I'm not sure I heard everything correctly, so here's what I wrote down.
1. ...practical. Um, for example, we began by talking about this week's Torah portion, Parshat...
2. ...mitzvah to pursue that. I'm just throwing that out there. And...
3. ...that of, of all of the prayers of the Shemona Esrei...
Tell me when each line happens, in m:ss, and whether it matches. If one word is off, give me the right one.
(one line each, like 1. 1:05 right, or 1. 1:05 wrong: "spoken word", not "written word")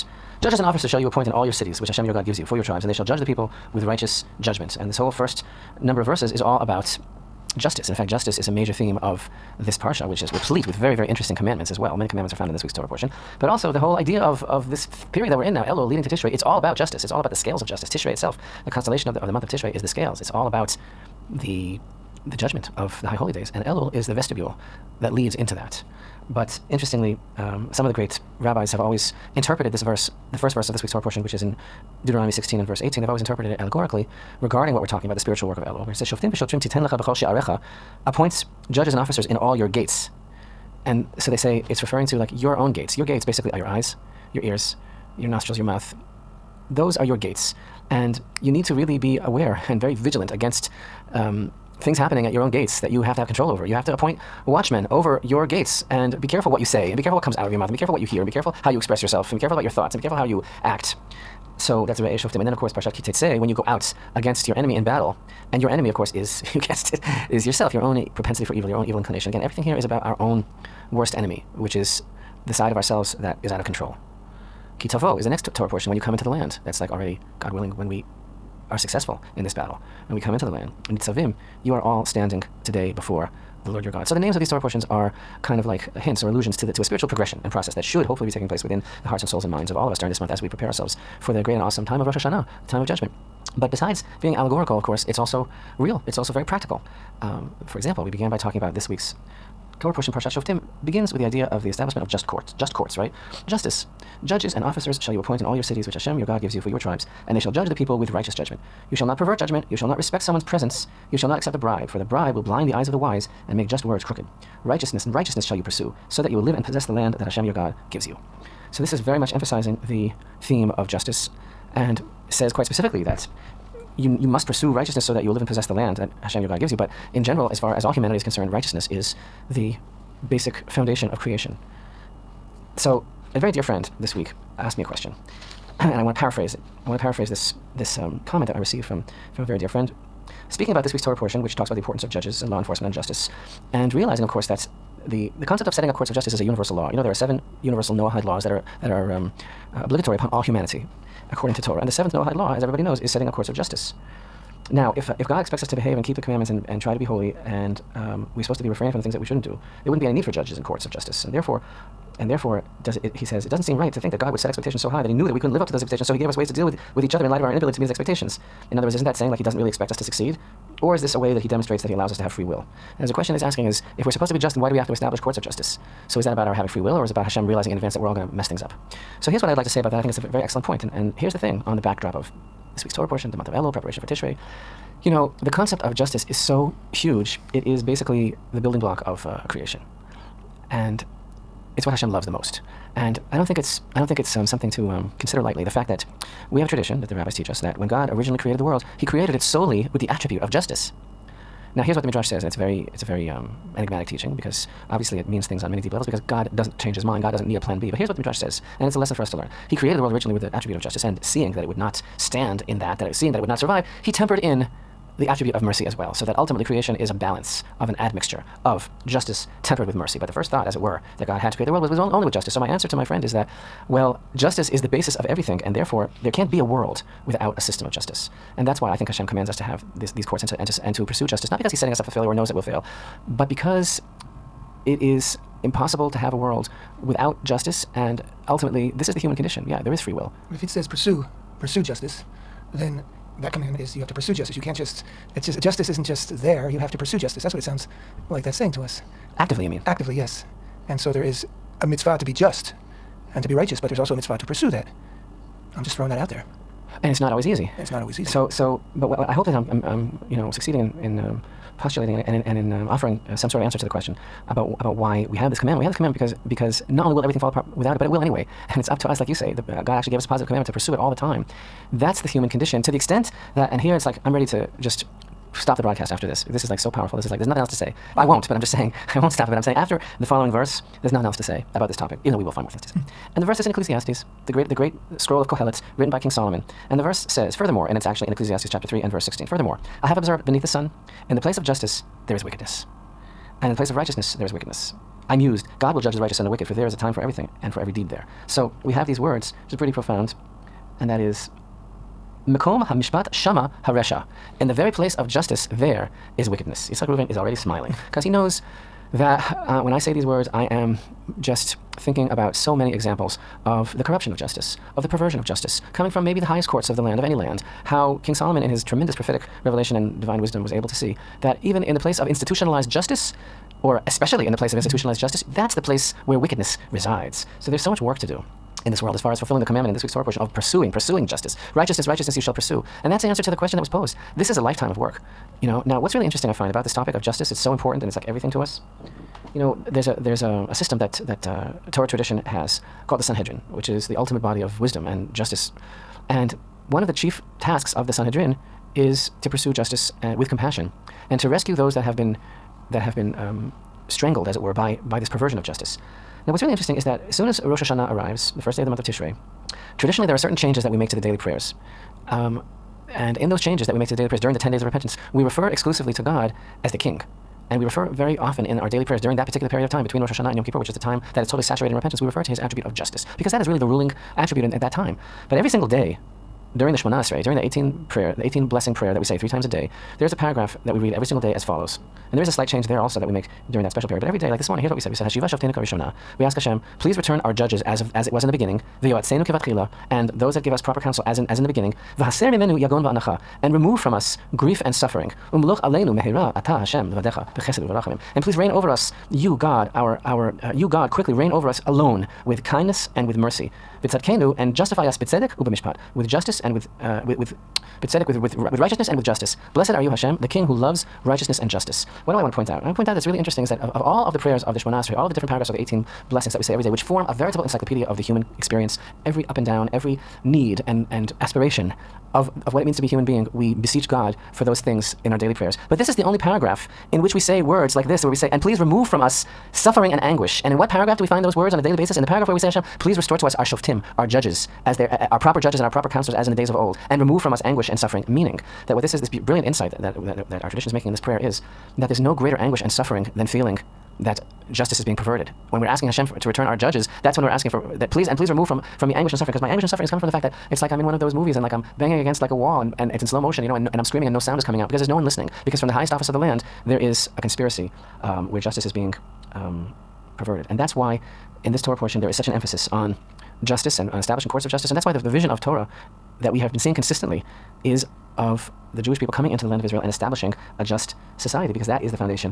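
1. 1:36 right
2. 4:14 right
3. 6:53 right.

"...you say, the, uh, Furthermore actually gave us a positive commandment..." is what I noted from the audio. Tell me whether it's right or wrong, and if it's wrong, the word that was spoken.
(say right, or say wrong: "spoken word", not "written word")
wrong: "God", not "Furthermore".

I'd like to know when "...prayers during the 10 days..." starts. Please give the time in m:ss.
6:04.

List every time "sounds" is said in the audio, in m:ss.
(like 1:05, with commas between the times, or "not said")
4:07, 7:34.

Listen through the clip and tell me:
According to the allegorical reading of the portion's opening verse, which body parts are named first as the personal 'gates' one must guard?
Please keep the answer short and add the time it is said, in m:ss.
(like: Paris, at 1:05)
Your eyes, at 0:43.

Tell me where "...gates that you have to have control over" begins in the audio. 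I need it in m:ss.
0:52.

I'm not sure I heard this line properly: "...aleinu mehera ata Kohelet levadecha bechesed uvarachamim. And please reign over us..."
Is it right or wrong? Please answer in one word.
wrong.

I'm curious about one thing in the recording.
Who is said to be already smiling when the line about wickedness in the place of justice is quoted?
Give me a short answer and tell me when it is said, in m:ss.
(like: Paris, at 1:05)
Yitzchak Reuven, at 5:06.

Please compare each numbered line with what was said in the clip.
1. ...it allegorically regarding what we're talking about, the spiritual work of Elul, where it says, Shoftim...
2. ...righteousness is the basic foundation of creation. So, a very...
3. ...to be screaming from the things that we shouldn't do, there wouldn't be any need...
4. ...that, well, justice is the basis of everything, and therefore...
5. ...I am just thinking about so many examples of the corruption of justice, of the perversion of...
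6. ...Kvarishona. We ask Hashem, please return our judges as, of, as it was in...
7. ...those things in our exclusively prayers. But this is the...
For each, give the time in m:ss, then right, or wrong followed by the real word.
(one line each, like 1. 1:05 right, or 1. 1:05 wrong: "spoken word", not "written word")
1. 0:33 right
2. 2:08 right
3. 2:38 wrong: "refraining", not "screaming"
4. 3:43 right
5. 5:10 right
6. 6:25 right
7. 7:04 wrong: "daily", not "exclusively".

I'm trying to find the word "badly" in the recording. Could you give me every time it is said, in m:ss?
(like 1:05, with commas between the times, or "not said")
not said.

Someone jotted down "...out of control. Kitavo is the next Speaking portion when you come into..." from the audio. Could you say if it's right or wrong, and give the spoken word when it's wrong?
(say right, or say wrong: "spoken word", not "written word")
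wrong: "Torah", not "Speaking".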